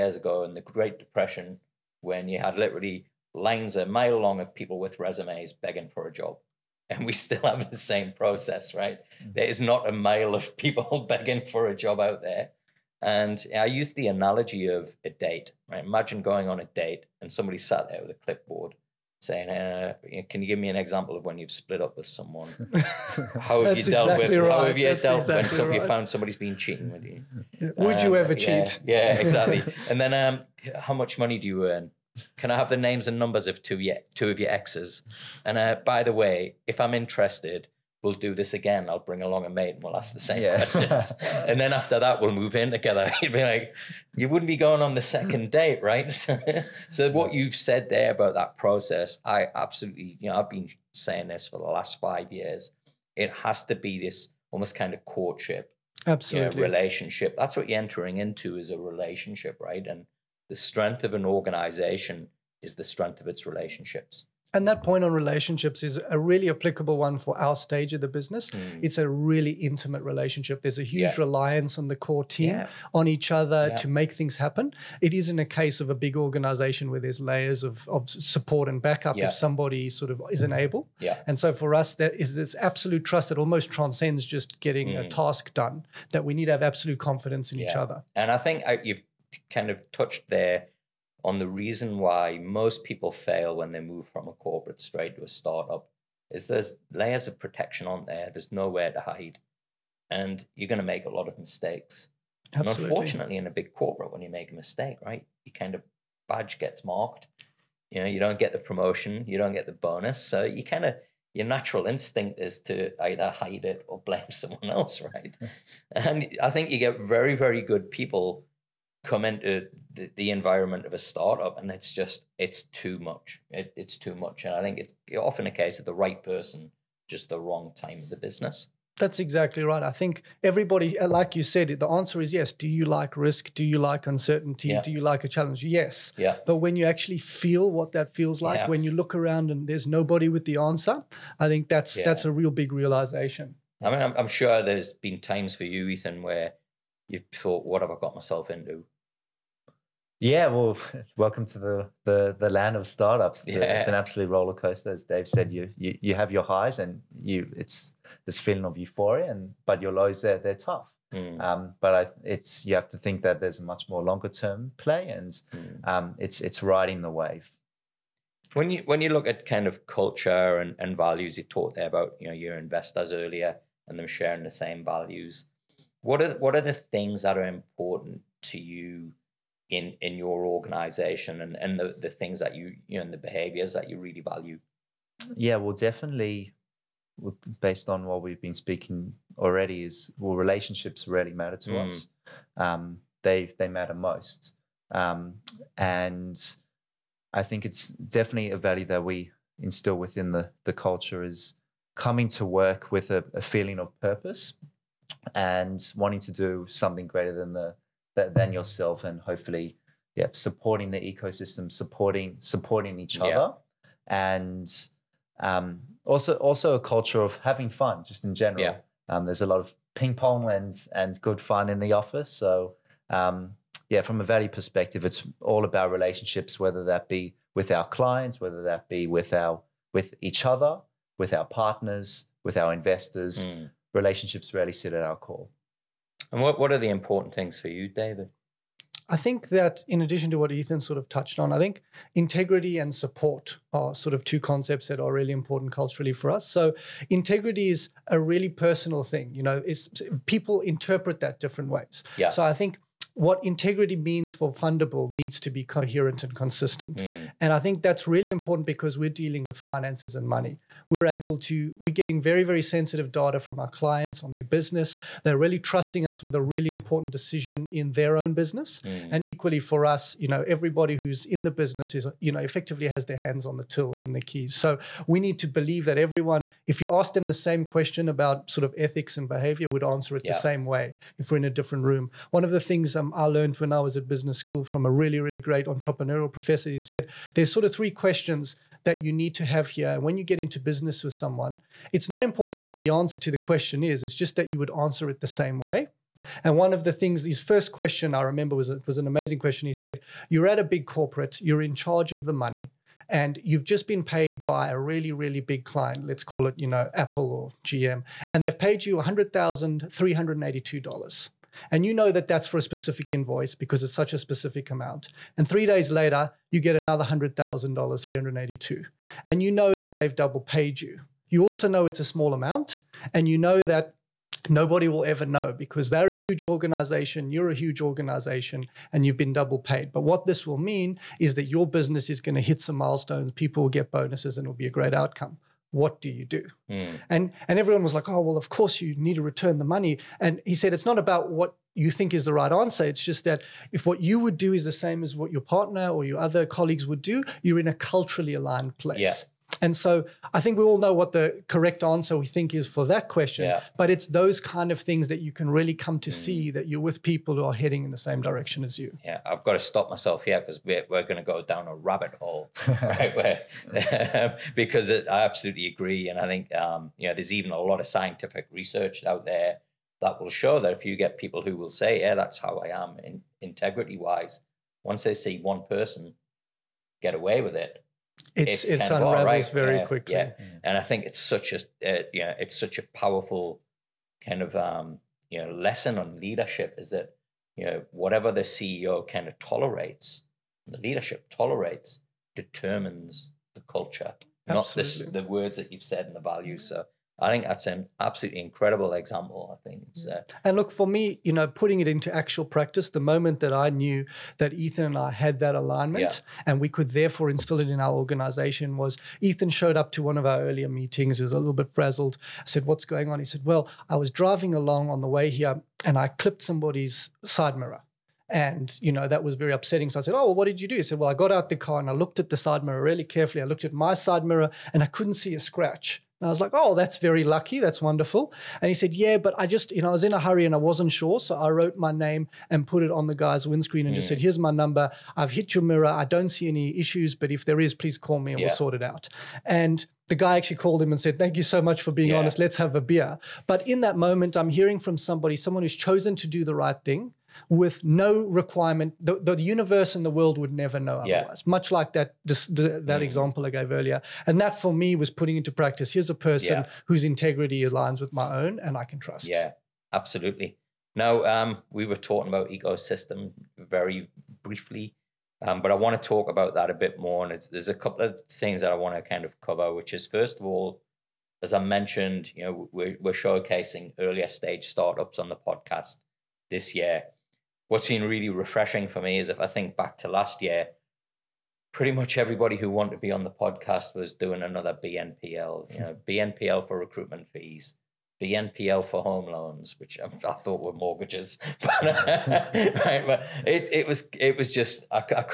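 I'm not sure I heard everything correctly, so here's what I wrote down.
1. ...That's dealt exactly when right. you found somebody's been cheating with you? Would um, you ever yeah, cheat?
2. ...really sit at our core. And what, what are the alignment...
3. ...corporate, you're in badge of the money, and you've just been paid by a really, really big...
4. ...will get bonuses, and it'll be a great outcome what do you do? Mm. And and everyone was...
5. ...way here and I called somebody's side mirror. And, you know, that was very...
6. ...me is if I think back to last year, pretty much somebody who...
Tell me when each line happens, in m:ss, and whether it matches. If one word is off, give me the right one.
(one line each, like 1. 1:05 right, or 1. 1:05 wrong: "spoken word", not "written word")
1. 0:24 right
2. 3:54 wrong: "important", not "alignment"
3. 5:00 wrong: "charge", not "badge"
4. 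5:33 right
5. 6:55 wrong: "clipped", not "called"
6. 7:59 wrong: "everybody", not "somebody".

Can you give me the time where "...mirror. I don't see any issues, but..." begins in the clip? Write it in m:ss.
7:15.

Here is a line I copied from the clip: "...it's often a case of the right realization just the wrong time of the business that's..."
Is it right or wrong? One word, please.
wrong.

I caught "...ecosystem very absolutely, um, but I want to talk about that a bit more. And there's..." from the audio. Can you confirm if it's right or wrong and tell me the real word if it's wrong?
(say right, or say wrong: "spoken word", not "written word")
wrong: "briefly", not "absolutely".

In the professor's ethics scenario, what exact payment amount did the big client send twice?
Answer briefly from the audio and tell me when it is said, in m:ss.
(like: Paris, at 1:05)
$100,382, at 5:08.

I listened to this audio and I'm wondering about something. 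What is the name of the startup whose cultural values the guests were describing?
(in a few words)
Fundabl.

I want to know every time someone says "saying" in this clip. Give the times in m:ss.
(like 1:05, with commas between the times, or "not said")
0:19, 0:50.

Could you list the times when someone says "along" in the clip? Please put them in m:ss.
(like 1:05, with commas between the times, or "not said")
0:39, 6:54.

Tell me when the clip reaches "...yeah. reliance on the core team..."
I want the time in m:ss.
1:11.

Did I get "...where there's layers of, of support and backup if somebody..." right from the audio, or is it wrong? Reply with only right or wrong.
right.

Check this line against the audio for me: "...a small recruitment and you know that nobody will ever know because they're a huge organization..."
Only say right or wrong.
wrong.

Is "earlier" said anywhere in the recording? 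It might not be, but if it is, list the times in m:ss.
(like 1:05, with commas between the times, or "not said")
2:53, 6:50, 7:33, 7:53.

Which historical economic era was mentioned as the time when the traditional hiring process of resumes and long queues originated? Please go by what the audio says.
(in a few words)
Great Depression.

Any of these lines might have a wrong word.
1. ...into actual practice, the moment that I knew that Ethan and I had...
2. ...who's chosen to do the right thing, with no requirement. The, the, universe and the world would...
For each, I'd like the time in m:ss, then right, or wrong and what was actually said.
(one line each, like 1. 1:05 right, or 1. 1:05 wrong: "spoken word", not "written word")
1. 6:41 right
2. 7:25 right.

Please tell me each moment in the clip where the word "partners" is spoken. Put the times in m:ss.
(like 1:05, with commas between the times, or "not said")
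3:51, 5:45.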